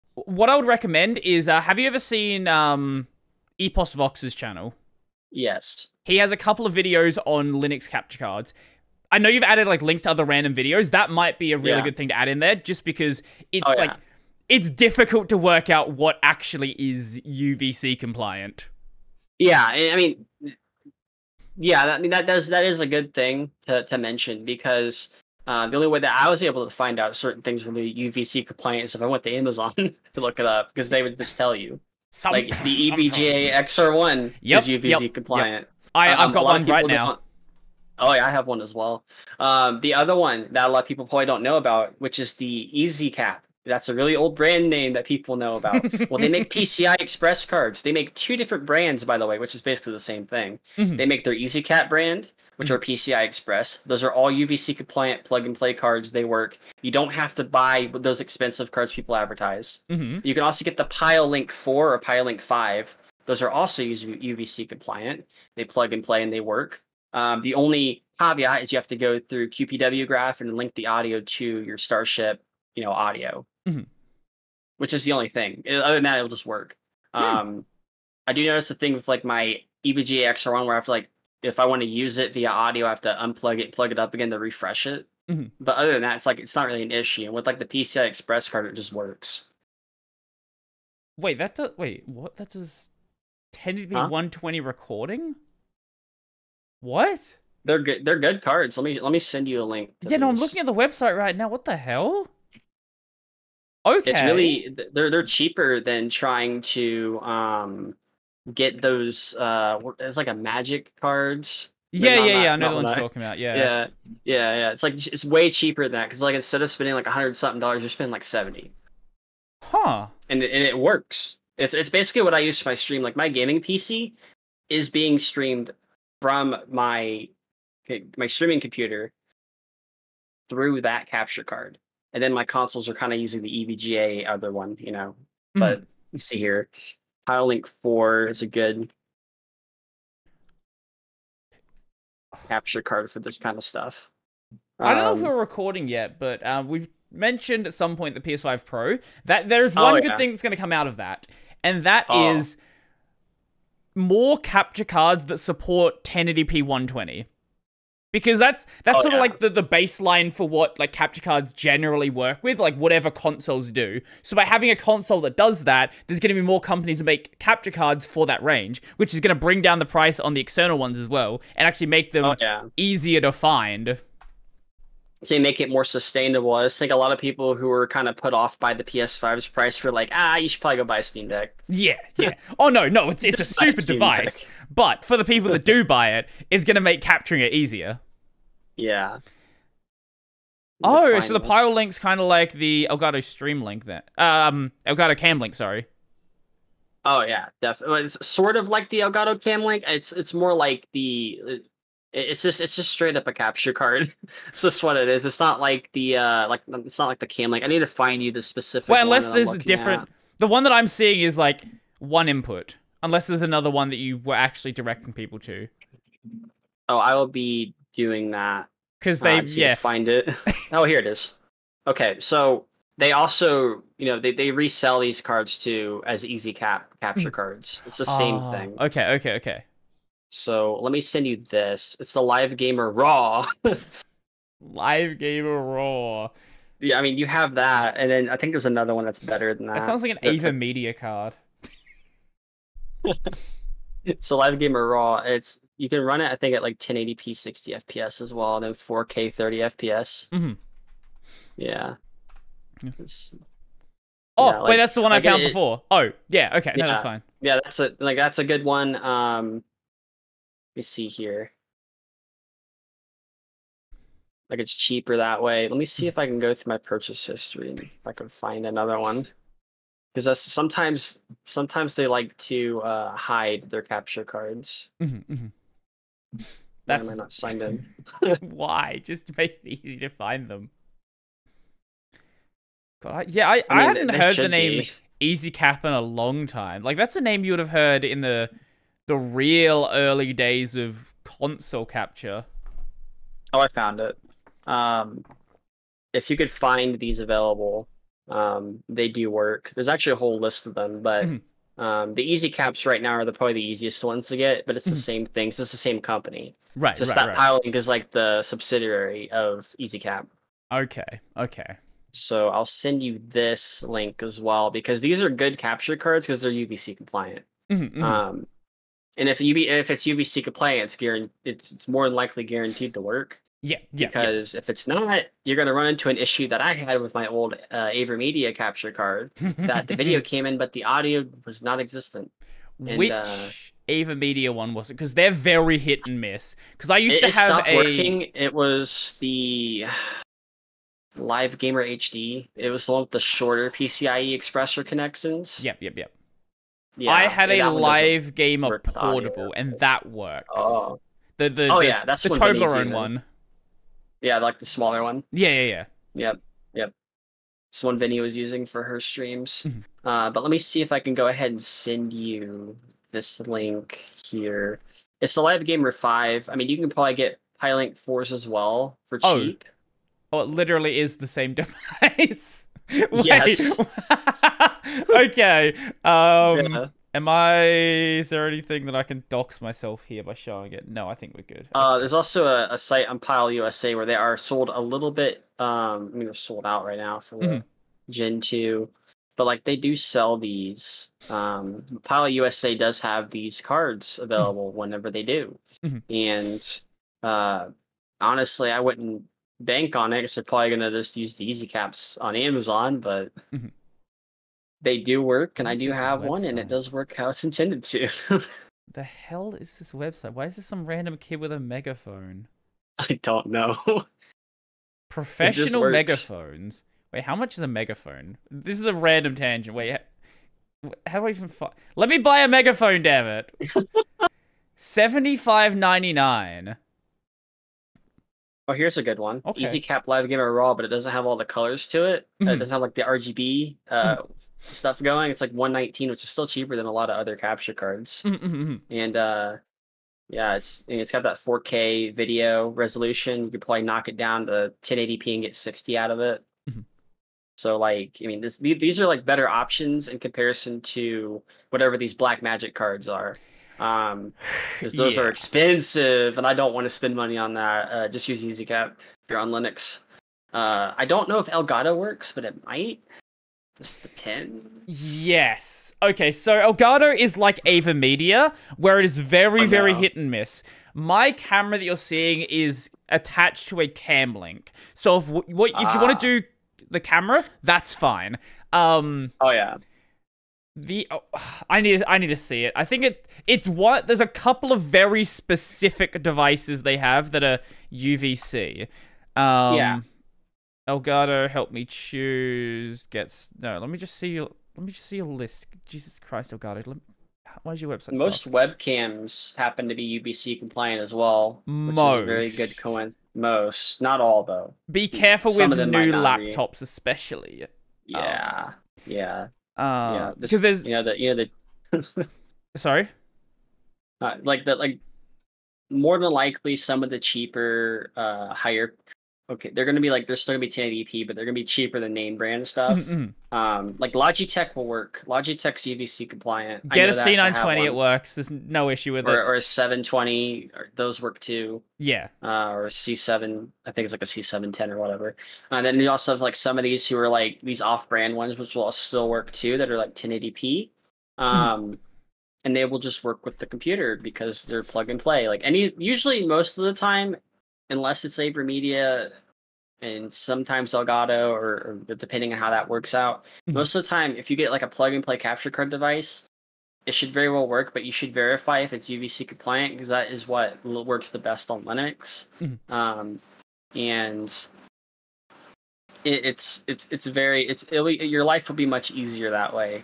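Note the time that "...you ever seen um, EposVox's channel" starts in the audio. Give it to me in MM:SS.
00:01.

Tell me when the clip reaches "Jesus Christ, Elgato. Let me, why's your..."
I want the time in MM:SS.
08:15.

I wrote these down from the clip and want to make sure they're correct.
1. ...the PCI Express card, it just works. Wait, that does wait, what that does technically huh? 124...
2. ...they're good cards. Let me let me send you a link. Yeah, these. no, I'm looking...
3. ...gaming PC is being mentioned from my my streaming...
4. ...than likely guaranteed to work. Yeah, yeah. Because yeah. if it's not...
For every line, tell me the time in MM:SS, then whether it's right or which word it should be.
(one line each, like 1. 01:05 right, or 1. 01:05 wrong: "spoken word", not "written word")
1. 01:27 wrong: "120", not "124"
2. 01:38 right
3. 02:03 wrong: "streamed", not "mentioned"
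4. 05:22 right.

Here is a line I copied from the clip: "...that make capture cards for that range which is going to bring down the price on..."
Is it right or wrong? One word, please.
right.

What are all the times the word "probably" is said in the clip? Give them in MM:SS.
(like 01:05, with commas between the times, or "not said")
00:41, 03:00, 05:03, 06:06, 06:40, 07:23.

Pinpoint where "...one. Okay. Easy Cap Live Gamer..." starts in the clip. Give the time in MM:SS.
07:09.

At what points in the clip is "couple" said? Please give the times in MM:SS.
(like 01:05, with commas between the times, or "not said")
00:06, 08:04.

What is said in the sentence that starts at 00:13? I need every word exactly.
like it's difficult to work out what actually is UVC compliant.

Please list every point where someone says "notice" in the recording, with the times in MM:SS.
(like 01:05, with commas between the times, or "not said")
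01:18.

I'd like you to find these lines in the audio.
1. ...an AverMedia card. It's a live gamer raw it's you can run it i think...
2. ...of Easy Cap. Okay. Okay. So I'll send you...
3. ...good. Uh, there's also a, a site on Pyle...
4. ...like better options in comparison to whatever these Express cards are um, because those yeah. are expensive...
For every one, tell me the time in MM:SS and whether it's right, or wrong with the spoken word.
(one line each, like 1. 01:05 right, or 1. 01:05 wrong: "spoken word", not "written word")
1. 04:00 right
2. 05:09 right
3. 06:21 right
4. 07:29 wrong: "Blackmagic", not "Express".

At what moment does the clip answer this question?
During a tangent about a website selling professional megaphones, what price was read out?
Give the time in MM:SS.
07:04.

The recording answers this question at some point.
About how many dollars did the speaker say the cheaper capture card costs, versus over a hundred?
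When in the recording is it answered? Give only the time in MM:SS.
01:58.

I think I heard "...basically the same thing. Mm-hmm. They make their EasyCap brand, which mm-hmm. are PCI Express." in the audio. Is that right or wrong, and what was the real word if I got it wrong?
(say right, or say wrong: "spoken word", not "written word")
right.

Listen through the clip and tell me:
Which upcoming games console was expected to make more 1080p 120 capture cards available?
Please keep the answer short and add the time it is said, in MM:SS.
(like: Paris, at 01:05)
PS5 Pro, at 02:28.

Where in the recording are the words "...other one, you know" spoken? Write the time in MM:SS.
02:14.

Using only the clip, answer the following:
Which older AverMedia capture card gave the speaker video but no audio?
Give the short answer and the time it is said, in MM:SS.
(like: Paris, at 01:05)
Live Gamer HD, at 05:41.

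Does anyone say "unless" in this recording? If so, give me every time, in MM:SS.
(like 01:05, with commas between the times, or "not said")
03:29, 03:33, 09:07.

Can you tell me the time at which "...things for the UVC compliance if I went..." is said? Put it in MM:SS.
00:27.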